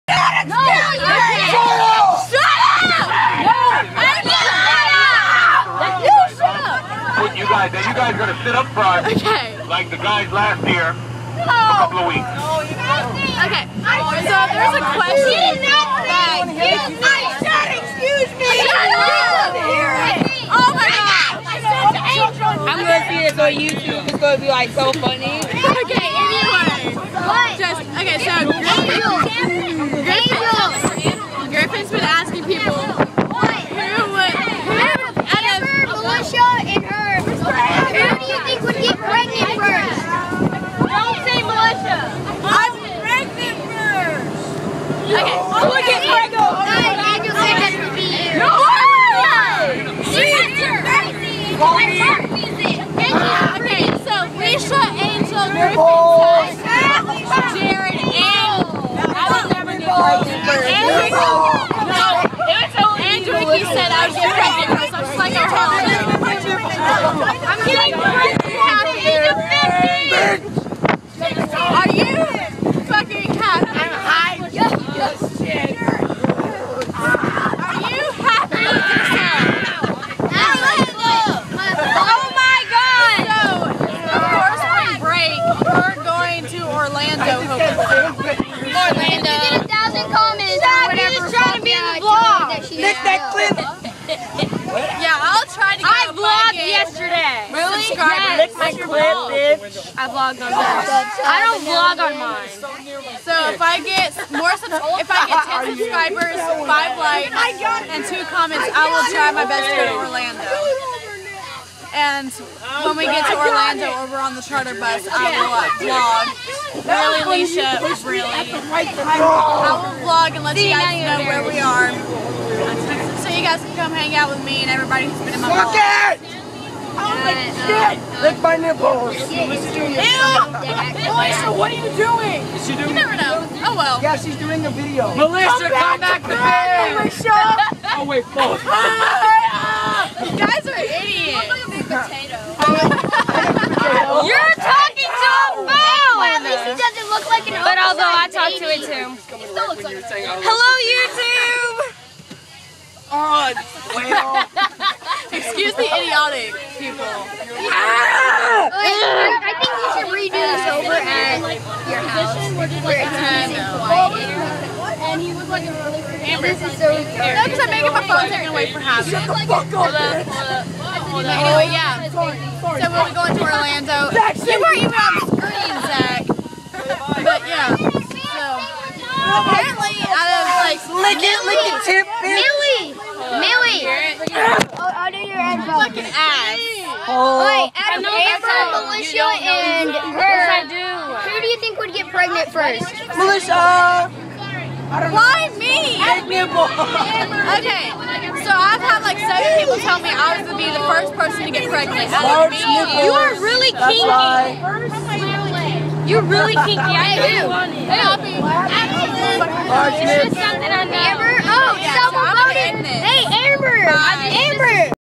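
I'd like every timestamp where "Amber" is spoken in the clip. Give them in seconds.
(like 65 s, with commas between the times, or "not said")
166 s, 188 s.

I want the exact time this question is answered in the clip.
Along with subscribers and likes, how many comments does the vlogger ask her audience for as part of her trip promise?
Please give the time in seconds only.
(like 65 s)
108 s.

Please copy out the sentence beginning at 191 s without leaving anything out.
who do you think would get pregnant first?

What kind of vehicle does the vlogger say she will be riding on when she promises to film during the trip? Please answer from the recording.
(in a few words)
charter bus.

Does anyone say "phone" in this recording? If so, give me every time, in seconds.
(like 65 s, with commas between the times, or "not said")
145 s, 168 s.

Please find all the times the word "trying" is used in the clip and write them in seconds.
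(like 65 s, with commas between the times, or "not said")
91 s.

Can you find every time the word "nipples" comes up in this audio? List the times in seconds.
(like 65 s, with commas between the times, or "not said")
128 s, 202 s, 210 s.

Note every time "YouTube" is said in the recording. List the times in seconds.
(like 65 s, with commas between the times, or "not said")
23 s, 150 s.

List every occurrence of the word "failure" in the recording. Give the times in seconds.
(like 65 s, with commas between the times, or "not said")
0 s.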